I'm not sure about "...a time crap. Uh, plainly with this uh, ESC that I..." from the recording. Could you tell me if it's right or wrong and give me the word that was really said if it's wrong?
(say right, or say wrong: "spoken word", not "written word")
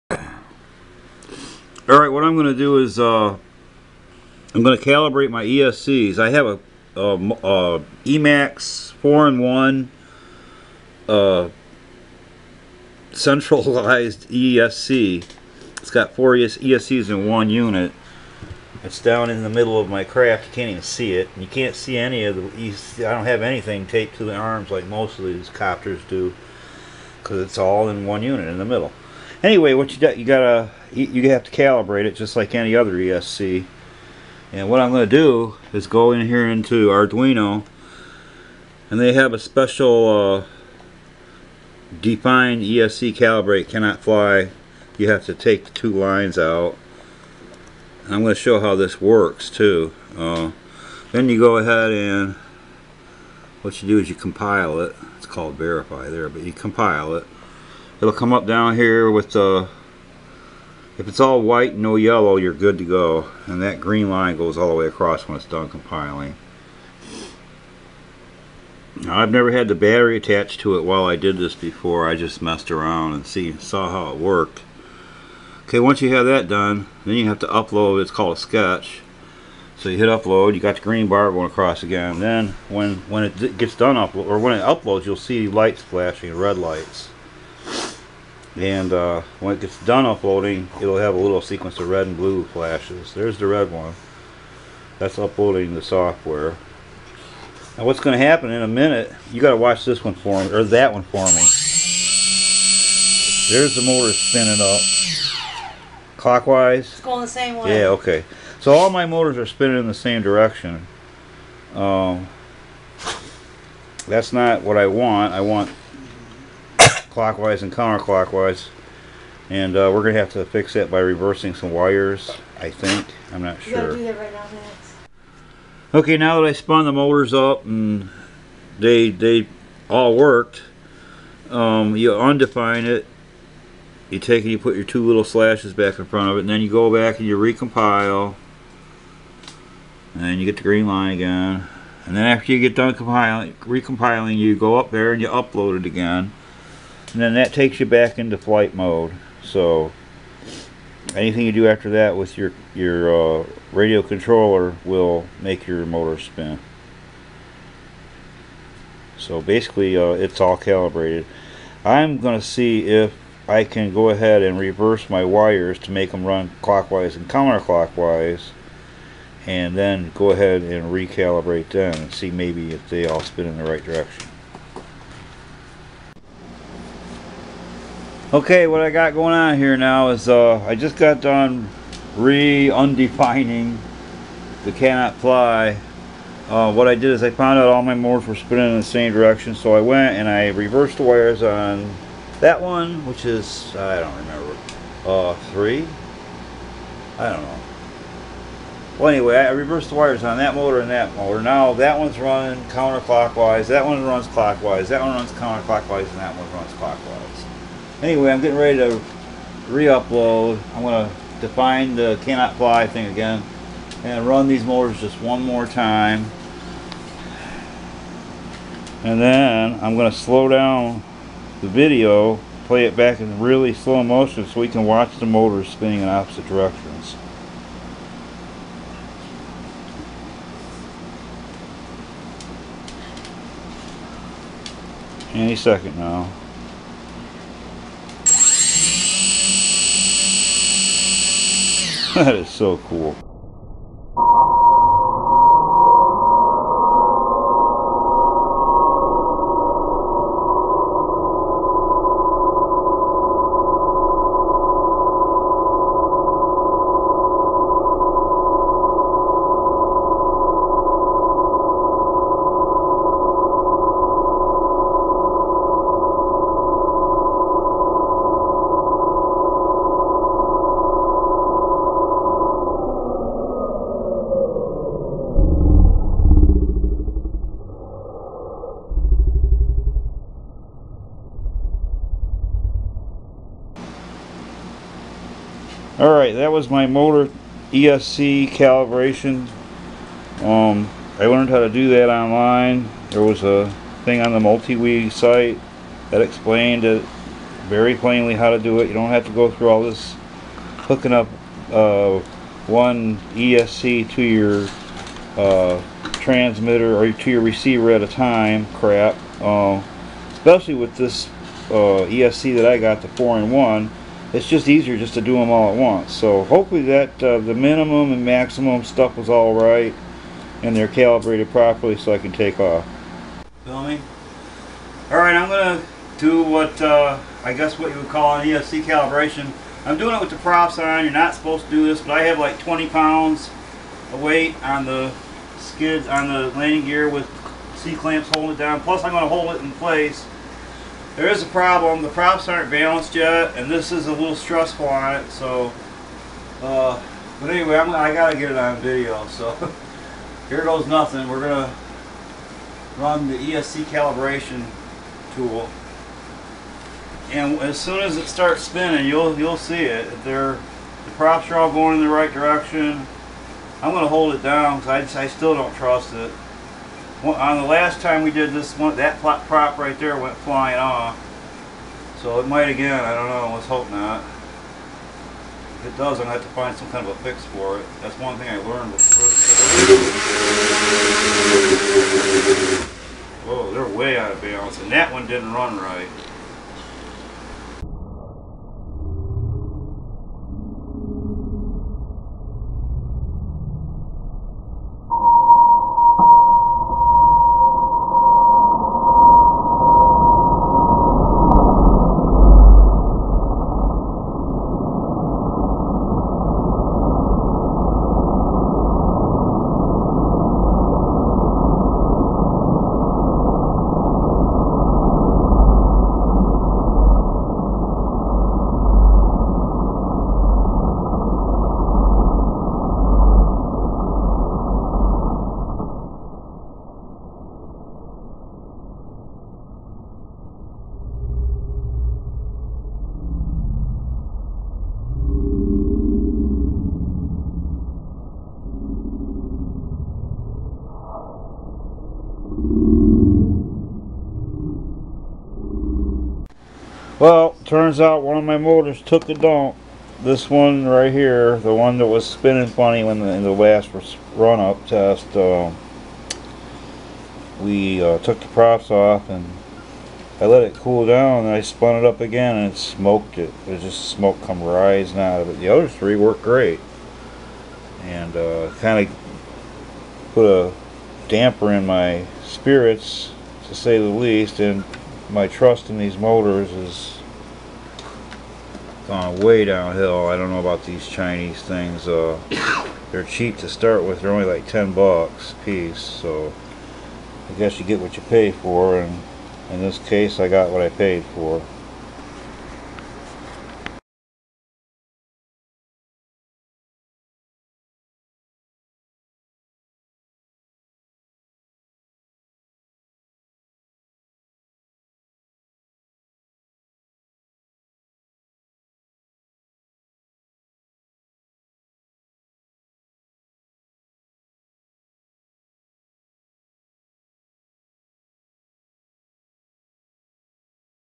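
wrong: "especially", not "plainly".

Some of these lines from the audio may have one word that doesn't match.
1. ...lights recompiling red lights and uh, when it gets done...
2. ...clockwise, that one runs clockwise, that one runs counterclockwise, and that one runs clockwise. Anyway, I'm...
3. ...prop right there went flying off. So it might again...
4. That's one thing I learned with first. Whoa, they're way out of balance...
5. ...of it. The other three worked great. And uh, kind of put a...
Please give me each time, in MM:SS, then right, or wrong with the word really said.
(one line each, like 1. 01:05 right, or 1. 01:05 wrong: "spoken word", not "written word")
1. 01:25 wrong: "flashing", not "recompiling"
2. 03:22 wrong: "counterclockwise", not "clockwise"
3. 06:09 right
4. 06:18 right
5. 07:45 right.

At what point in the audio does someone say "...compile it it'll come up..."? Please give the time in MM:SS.
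00:56.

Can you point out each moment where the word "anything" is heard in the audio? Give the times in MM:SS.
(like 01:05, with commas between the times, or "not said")
00:23, 02:31.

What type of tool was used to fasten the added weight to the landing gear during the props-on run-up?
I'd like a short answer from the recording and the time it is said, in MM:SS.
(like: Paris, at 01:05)
C-clamps, at 05:37.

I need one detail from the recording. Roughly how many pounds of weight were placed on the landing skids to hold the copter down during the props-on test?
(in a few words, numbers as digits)
20 pounds.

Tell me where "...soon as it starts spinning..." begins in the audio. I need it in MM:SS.
05:57.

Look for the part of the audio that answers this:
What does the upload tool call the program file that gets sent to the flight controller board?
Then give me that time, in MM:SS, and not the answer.
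01:18.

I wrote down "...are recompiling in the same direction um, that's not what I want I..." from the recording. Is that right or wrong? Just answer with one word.
wrong.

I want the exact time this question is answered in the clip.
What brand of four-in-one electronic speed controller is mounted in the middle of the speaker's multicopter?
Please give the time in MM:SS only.
00:08.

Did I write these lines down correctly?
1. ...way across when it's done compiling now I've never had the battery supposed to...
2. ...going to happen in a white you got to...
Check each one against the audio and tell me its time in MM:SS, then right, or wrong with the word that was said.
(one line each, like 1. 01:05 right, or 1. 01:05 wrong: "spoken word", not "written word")
1. 01:04 wrong: "attached", not "supposed"
2. 01:38 wrong: "minute", not "white".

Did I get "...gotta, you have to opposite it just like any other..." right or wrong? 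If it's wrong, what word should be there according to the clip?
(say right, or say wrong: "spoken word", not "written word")
wrong: "calibrate", not "opposite".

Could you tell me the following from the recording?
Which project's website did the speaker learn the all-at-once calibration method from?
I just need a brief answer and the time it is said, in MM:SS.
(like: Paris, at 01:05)
MultiWii, at 04:54.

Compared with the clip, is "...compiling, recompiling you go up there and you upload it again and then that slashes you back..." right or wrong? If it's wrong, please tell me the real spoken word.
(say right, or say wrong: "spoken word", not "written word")
wrong: "takes", not "slashes".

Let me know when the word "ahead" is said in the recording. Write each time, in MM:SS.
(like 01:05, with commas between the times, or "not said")
00:51, 02:44, 02:50.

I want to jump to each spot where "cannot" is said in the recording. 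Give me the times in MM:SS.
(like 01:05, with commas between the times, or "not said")
00:43, 03:04, 03:32.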